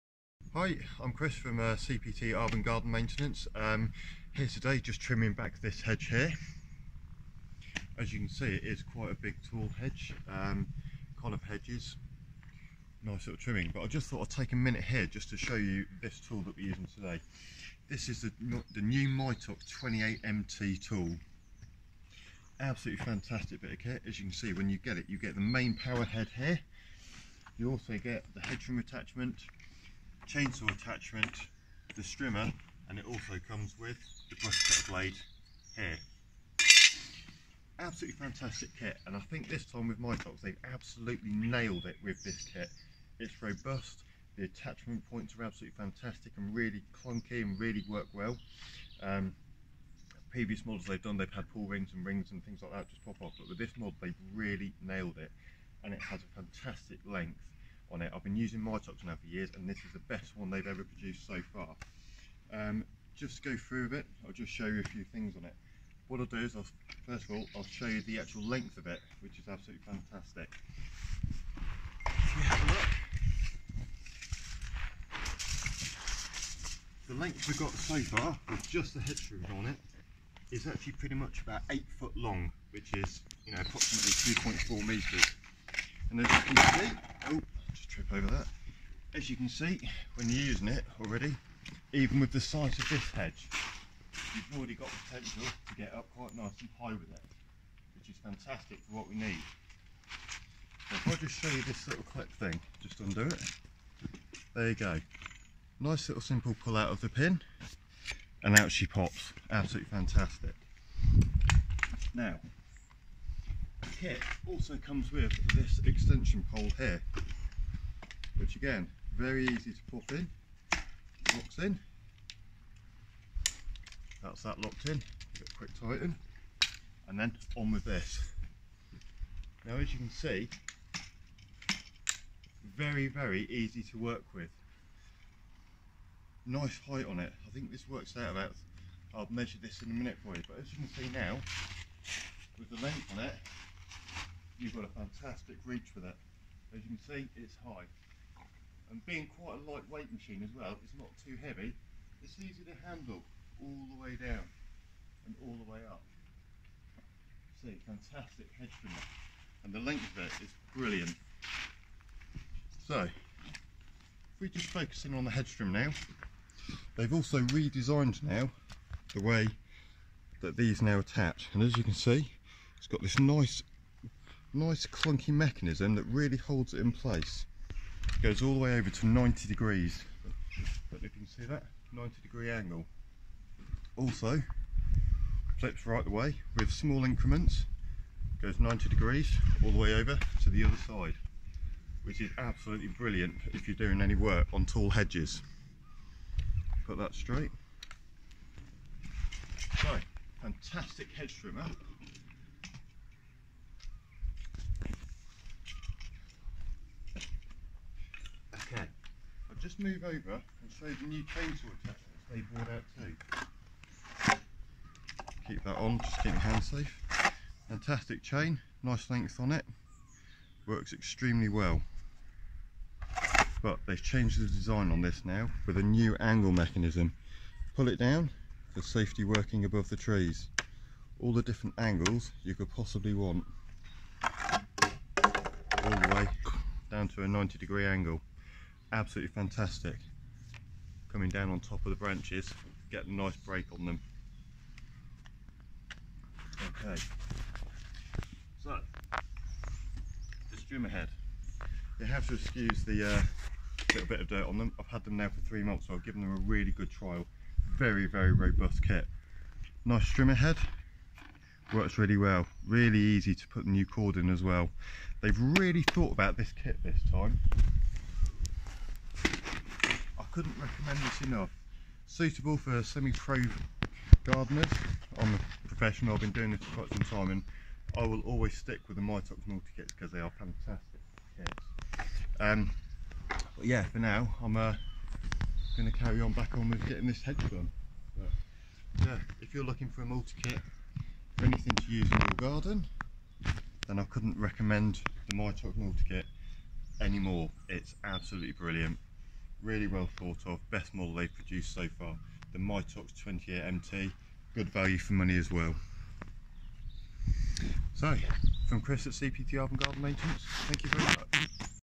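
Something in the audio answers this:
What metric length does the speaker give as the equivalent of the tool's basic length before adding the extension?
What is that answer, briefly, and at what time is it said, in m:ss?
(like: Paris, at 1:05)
2.4 metres, at 1:24.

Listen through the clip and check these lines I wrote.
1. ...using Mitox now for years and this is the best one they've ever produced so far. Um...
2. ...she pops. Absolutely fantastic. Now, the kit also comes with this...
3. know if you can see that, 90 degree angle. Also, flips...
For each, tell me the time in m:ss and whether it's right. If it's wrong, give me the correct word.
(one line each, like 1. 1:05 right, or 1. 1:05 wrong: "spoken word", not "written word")
1. 0:58 right
2. 1:48 right
3. 3:00 right.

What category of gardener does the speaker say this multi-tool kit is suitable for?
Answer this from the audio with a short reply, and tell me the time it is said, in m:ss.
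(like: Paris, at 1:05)
Semi-pro gardeners, at 4:32.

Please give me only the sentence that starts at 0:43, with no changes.
It's robust, the attachment points are absolutely fantastic and really clunky and really work well.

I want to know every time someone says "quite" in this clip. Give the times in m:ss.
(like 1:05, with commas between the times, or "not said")
0:08, 1:36, 2:29, 4:36.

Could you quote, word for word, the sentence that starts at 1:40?
So if I just show you this little clip thing, just undo it.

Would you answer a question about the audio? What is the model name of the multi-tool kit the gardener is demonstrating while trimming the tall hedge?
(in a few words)
Mitox 28MT.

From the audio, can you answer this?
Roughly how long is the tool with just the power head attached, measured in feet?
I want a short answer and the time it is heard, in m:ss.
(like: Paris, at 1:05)
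8 foot, at 1:21.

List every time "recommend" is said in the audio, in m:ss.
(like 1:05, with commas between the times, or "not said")
4:30, 4:54.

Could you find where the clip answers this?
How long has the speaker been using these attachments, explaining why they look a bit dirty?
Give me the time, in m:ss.
4:15.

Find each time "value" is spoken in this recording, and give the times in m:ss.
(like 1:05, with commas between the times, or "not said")
5:04.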